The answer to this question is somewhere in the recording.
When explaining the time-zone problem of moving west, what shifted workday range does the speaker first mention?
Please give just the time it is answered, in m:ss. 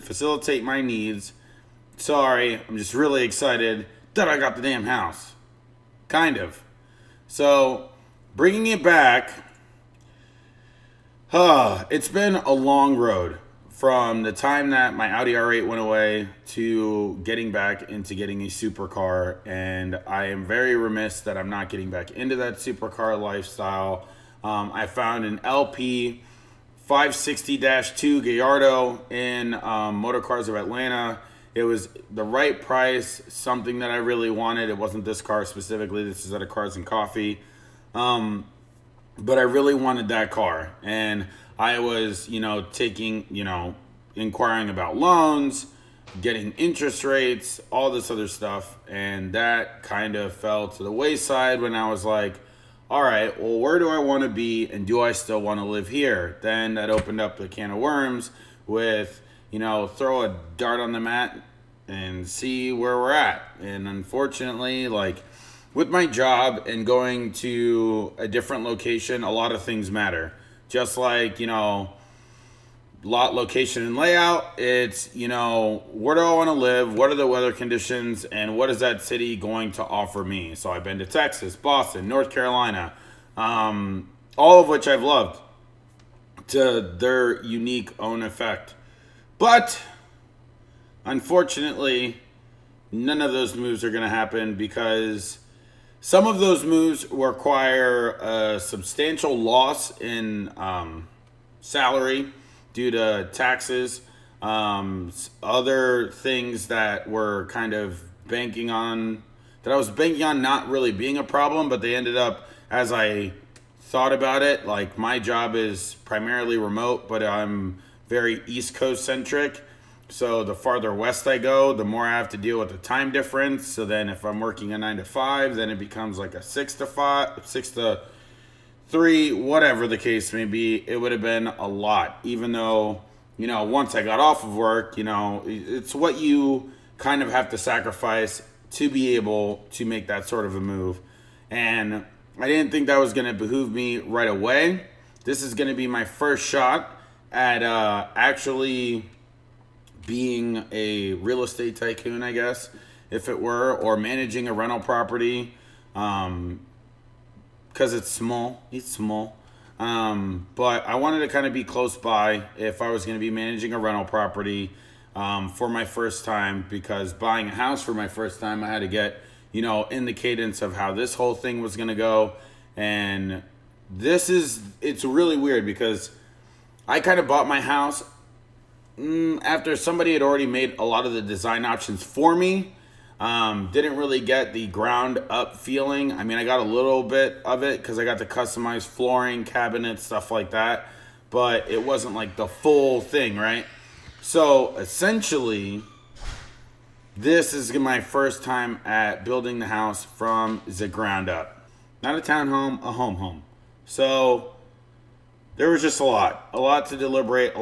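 2:06.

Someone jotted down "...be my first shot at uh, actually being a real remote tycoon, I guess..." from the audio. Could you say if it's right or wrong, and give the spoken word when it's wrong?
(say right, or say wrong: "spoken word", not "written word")
wrong: "estate", not "remote".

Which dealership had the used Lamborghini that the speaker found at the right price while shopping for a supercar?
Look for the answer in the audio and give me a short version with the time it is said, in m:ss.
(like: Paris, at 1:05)
Motorcars of Atlanta, at 0:29.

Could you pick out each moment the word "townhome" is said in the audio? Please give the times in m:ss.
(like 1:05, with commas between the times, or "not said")
3:22.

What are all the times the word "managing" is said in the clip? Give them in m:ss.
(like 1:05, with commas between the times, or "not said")
2:33, 2:43.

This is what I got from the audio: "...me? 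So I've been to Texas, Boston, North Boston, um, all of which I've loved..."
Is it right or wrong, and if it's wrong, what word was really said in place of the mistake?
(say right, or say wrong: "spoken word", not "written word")
wrong: "Carolina", not "Boston".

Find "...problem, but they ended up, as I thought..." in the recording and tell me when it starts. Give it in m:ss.
1:51.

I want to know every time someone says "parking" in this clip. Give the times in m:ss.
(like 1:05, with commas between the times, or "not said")
not said.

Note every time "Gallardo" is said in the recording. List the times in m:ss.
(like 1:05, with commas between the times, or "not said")
0:28.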